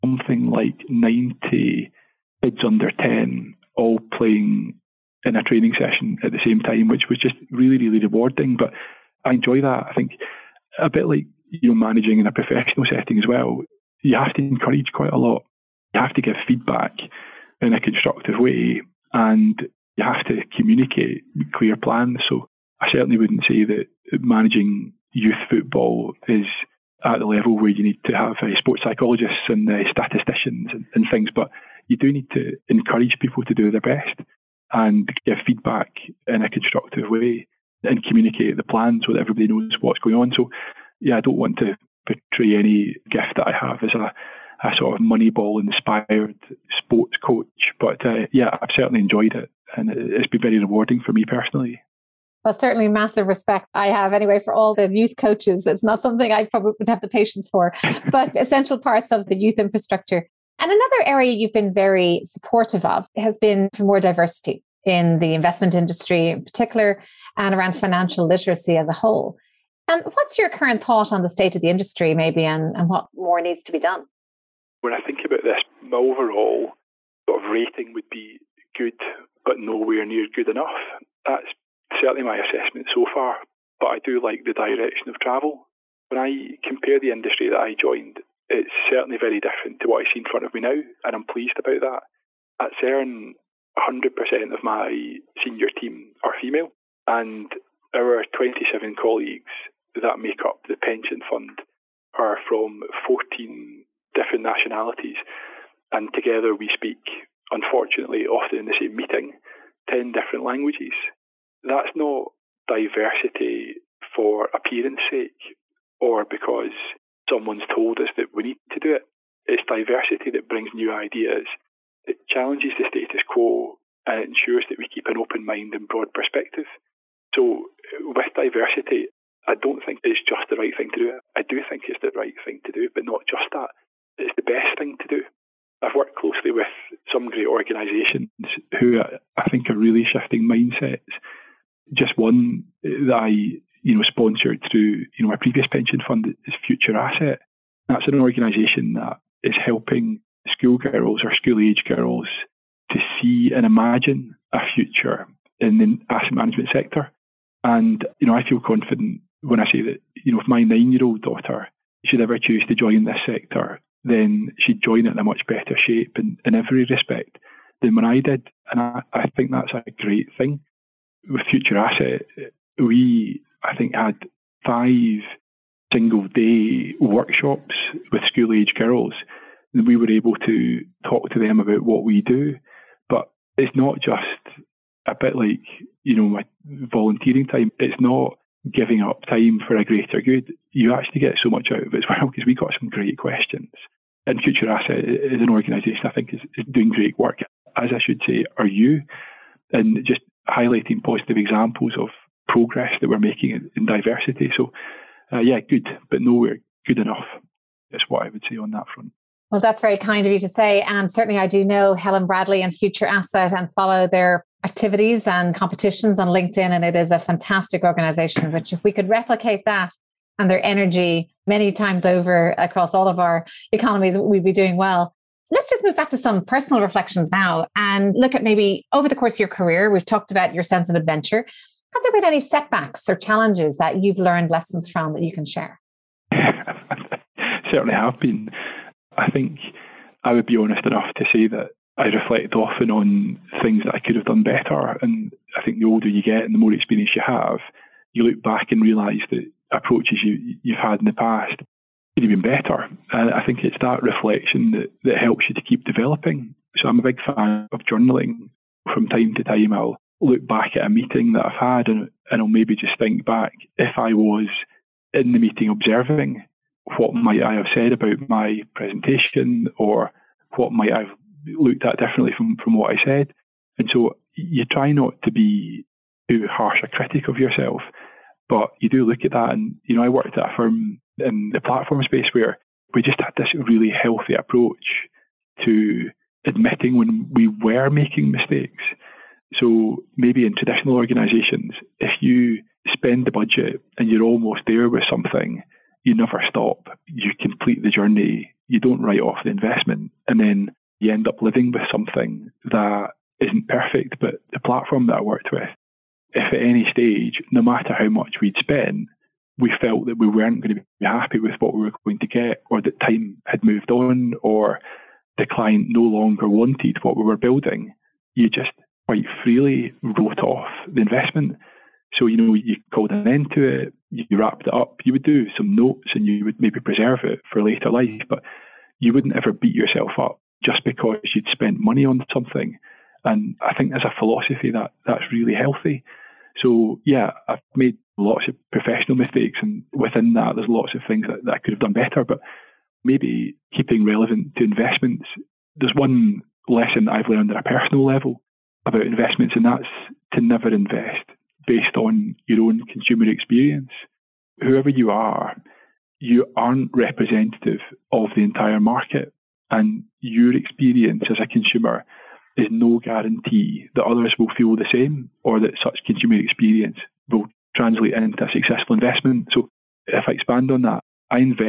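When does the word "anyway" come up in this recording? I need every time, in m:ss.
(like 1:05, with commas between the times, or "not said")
0:54.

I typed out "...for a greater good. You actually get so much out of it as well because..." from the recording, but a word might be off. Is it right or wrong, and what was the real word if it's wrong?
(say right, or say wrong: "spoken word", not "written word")
right.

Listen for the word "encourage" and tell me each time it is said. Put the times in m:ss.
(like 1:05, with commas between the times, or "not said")
0:14, 0:32.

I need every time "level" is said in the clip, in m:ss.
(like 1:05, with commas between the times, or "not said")
0:27, 5:48.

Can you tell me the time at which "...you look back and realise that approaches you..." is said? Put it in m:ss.
4:08.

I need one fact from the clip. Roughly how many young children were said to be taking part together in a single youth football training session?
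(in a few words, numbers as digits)
90.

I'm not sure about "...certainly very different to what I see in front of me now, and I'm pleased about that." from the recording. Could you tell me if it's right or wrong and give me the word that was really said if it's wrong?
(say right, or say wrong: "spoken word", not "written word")
right.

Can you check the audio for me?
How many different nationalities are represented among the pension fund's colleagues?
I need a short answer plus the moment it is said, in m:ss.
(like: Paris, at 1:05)
14, at 1:43.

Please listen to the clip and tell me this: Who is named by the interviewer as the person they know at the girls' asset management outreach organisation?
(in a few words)
Helen Bradley.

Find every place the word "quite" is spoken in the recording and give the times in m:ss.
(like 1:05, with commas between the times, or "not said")
0:14, 5:19.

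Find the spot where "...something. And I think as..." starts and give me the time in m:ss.
5:32.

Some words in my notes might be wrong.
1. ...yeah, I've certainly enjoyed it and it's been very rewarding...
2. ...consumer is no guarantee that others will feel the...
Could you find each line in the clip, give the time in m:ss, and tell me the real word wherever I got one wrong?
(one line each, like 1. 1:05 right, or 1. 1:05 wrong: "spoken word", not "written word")
1. 0:48 right
2. 6:01 right.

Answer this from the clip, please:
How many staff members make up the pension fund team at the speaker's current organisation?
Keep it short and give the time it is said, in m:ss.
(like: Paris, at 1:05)
27, at 1:38.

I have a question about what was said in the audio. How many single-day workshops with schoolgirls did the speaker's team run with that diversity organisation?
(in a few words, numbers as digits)
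5.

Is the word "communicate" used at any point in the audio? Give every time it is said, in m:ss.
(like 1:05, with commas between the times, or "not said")
0:20, 0:38.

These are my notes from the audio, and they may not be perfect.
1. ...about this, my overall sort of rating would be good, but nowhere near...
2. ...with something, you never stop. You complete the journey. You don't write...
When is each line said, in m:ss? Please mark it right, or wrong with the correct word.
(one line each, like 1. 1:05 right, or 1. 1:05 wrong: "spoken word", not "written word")
1. 1:15 right
2. 4:54 right.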